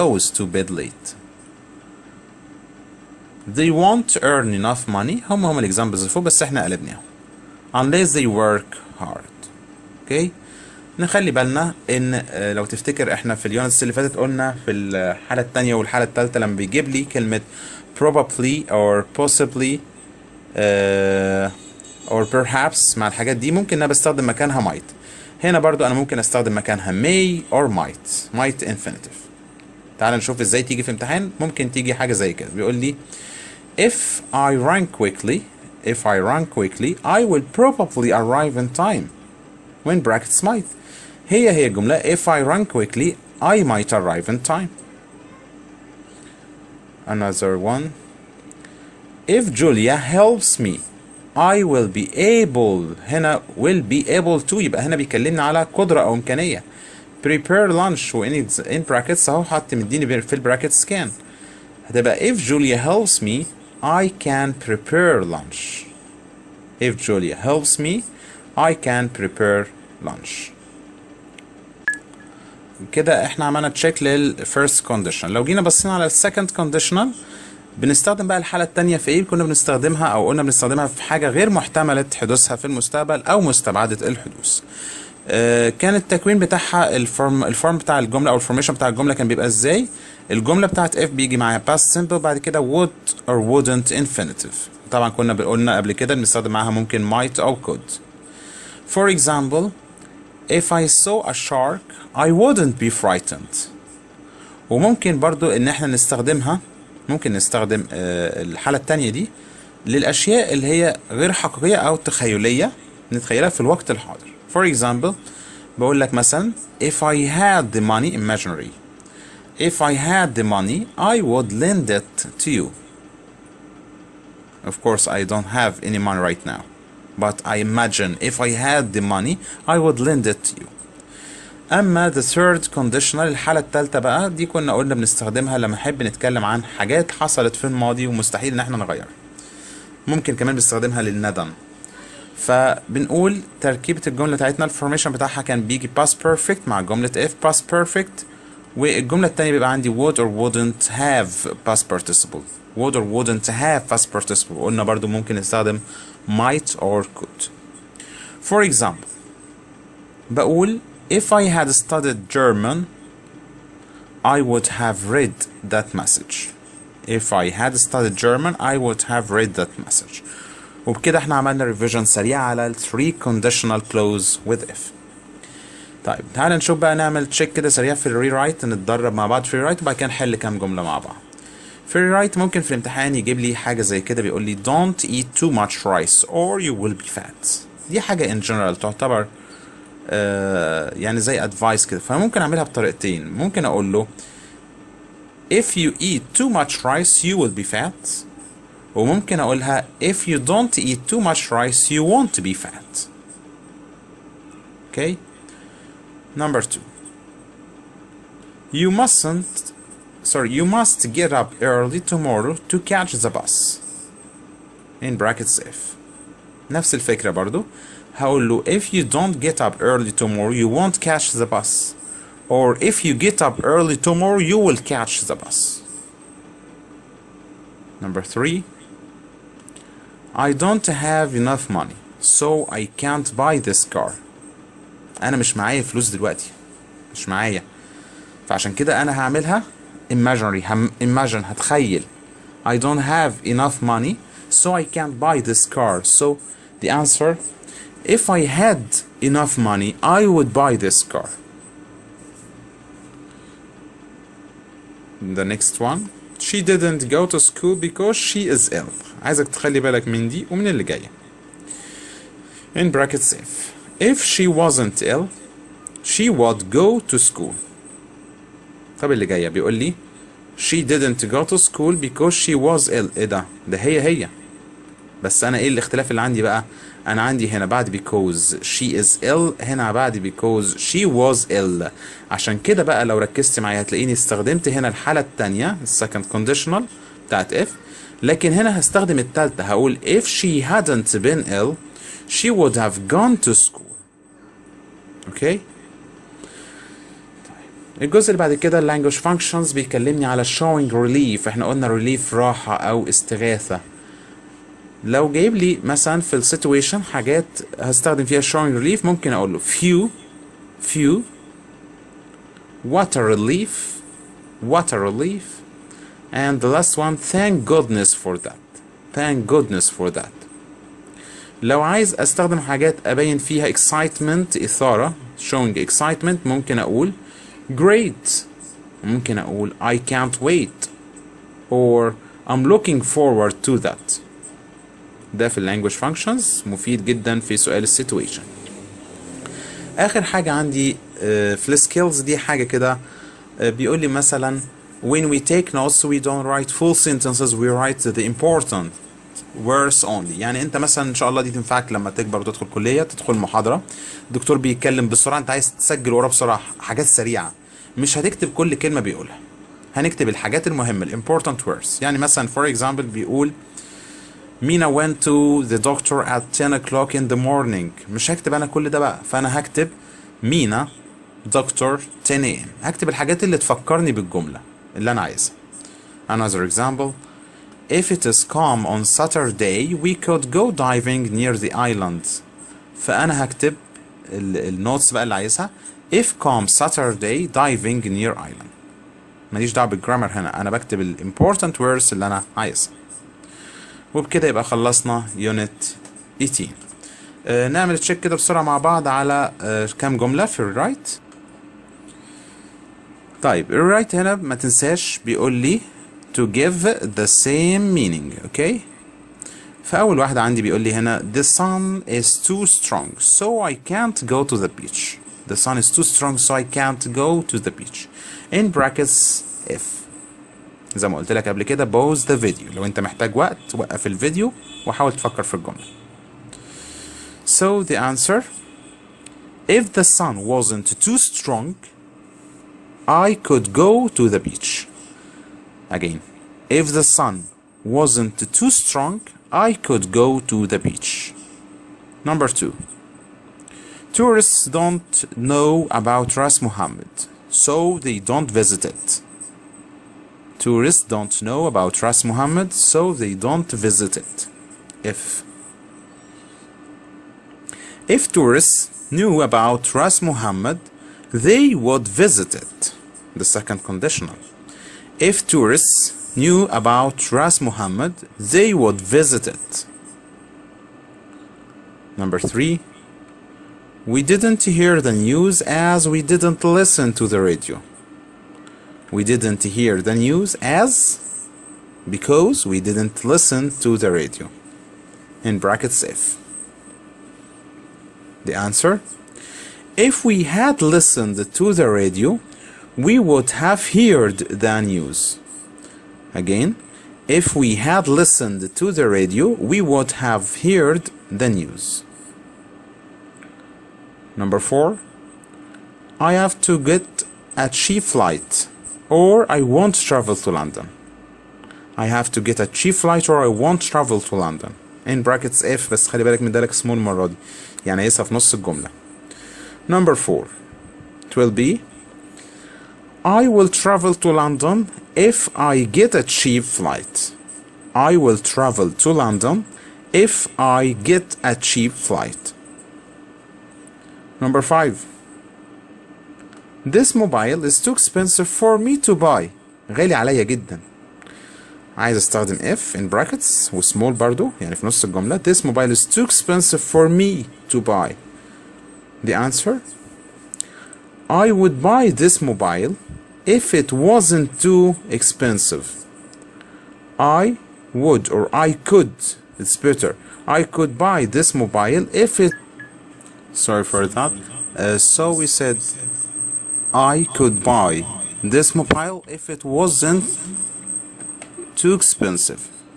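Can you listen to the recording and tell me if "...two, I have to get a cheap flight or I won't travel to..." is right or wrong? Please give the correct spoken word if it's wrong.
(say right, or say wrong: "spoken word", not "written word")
wrong: "four", not "two".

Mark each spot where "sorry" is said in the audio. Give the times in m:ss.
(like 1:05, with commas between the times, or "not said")
3:30, 9:23.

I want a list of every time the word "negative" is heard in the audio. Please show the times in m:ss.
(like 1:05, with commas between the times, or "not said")
not said.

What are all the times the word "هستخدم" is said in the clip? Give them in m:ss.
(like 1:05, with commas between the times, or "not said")
4:48, 5:07.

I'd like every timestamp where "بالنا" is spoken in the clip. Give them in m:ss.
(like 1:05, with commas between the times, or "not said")
0:11.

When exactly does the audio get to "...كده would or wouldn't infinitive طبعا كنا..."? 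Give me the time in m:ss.
1:32.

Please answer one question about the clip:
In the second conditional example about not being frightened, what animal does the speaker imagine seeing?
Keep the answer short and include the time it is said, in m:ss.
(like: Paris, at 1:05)
a shark, at 1:40.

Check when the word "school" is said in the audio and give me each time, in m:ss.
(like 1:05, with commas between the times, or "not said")
4:17, 4:27, 4:31, 4:53.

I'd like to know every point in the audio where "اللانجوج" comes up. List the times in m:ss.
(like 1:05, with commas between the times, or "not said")
4:58.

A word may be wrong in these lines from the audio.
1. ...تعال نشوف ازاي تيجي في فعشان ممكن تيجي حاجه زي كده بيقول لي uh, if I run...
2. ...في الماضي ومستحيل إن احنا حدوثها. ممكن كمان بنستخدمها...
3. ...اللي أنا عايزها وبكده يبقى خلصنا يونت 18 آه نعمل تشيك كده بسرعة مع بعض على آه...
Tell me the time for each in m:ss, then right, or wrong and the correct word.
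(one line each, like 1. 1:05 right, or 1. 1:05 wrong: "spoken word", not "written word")
1. 0:29 wrong: "امتحان", not "فعشان"
2. 2:17 wrong: "نغيرها", not "حدوثها"
3. 6:32 right.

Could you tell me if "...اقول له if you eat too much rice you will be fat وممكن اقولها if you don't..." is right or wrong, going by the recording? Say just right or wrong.
right.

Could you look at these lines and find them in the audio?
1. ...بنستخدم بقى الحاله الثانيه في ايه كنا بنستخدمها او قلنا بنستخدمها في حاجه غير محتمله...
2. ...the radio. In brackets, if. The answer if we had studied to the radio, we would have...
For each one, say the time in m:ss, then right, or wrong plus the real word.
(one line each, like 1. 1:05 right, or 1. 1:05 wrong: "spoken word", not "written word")
1. 1:17 right
2. 8:03 wrong: "listened", not "studied".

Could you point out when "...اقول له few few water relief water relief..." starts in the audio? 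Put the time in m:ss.
5:09.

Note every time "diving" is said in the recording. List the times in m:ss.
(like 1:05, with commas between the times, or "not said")
6:20, 6:27.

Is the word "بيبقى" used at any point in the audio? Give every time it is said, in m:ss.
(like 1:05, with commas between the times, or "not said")
1:29, 2:29.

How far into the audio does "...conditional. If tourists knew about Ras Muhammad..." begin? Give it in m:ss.
7:43.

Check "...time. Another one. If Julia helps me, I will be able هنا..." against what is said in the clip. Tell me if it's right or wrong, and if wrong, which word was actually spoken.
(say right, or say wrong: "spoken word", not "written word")
right.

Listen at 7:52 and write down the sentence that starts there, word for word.
Number three, we didn't hear the news as we didn't listen to the radio.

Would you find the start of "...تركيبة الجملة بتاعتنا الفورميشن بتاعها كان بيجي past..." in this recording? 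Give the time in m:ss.
2:23.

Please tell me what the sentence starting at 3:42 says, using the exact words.
Or if you get up early tomorrow you will catch the bus.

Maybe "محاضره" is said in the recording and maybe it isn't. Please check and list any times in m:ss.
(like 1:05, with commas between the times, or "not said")
5:53.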